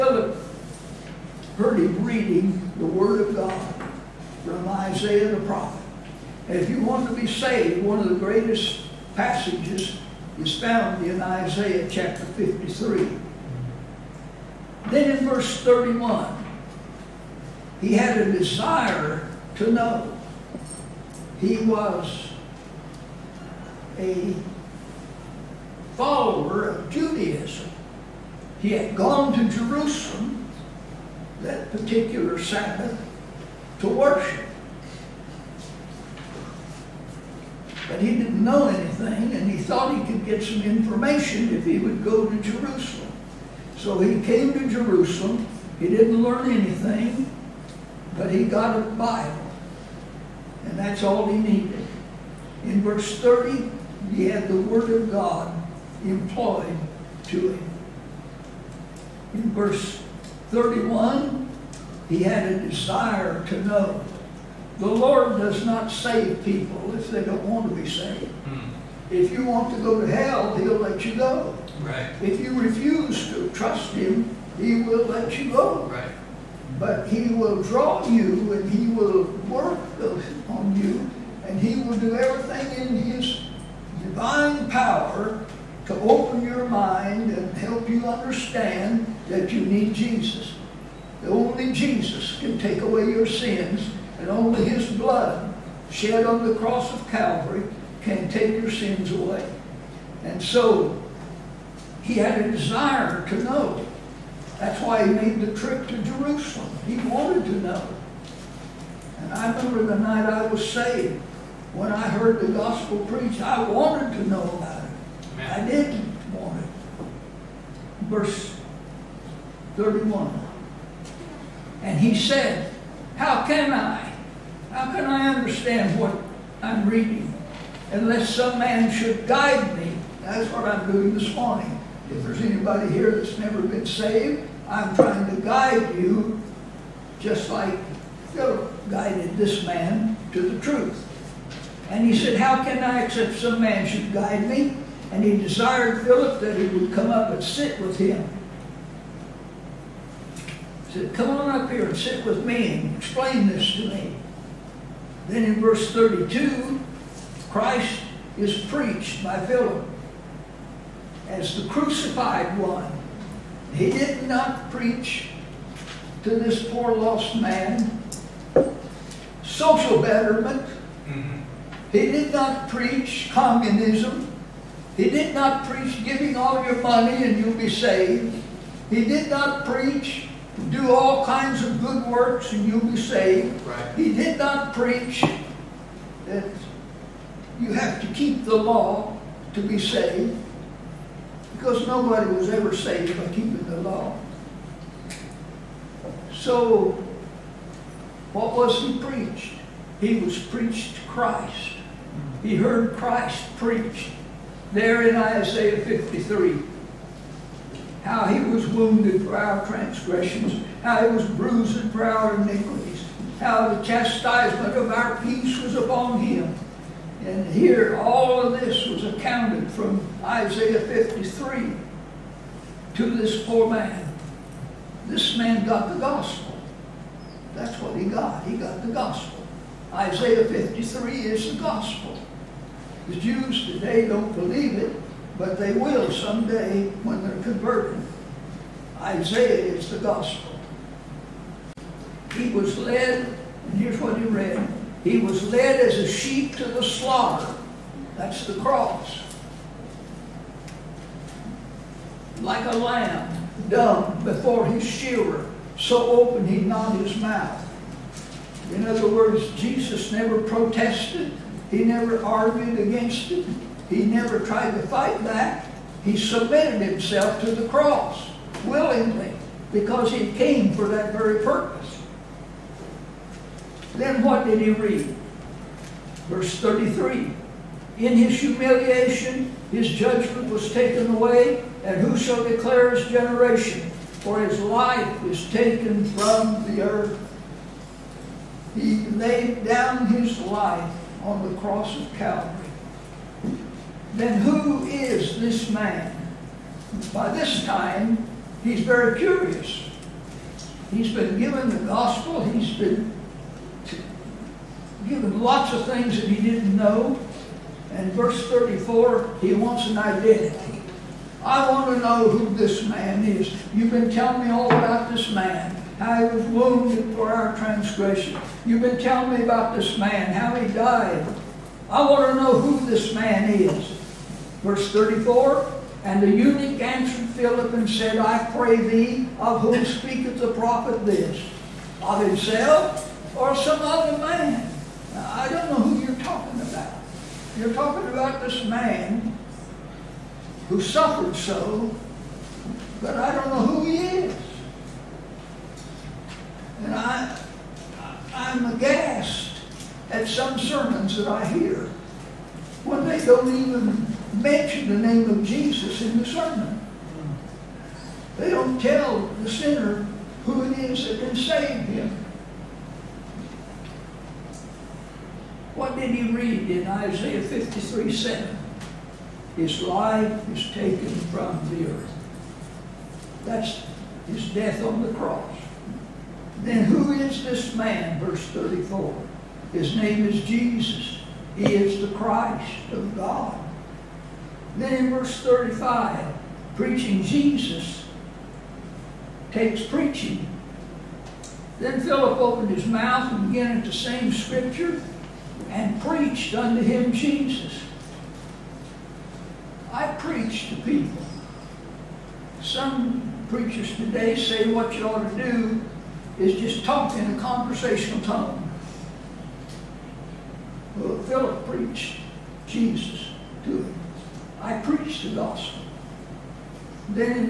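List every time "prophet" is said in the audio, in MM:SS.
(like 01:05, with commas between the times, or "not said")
00:05, 05:30.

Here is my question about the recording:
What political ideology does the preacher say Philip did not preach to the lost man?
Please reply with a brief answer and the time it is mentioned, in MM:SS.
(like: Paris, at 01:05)
Communism, at 02:53.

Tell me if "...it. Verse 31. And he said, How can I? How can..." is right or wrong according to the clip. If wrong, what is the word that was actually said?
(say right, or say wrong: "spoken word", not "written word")
right.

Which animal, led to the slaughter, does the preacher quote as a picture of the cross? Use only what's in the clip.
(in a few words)
A sheep.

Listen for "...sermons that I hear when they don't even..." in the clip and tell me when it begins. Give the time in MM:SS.
05:50.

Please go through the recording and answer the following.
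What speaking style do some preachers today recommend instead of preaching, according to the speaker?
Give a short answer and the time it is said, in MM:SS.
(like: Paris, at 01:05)
Conversational tone, at 06:47.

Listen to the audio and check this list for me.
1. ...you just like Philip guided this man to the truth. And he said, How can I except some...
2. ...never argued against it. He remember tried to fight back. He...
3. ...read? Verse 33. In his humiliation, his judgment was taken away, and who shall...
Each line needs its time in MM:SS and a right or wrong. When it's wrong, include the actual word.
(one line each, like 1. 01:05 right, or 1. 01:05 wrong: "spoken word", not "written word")
1. 02:15 right
2. 04:21 wrong: "never", not "remember"
3. 04:34 right.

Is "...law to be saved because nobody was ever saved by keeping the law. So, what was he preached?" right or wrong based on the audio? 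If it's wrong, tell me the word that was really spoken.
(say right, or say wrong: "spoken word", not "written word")
right.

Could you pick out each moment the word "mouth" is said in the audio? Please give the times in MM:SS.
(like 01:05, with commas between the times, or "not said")
04:17, 06:32.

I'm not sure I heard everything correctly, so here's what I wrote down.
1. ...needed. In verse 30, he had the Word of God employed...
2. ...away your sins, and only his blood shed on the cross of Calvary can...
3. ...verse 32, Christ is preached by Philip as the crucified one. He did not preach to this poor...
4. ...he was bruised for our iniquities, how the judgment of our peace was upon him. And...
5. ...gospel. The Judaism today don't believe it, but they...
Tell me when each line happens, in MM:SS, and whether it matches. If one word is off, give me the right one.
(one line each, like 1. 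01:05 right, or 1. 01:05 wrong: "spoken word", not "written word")
1. 00:51 right
2. 01:32 right
3. 02:35 right
4. 03:31 wrong: "chastisement", not "judgment"
5. 03:51 wrong: "Jews", not "Judaism".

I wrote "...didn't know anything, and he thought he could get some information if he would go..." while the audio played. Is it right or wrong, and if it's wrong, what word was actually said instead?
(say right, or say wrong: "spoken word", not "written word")
right.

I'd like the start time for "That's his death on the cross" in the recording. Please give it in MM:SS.
06:13.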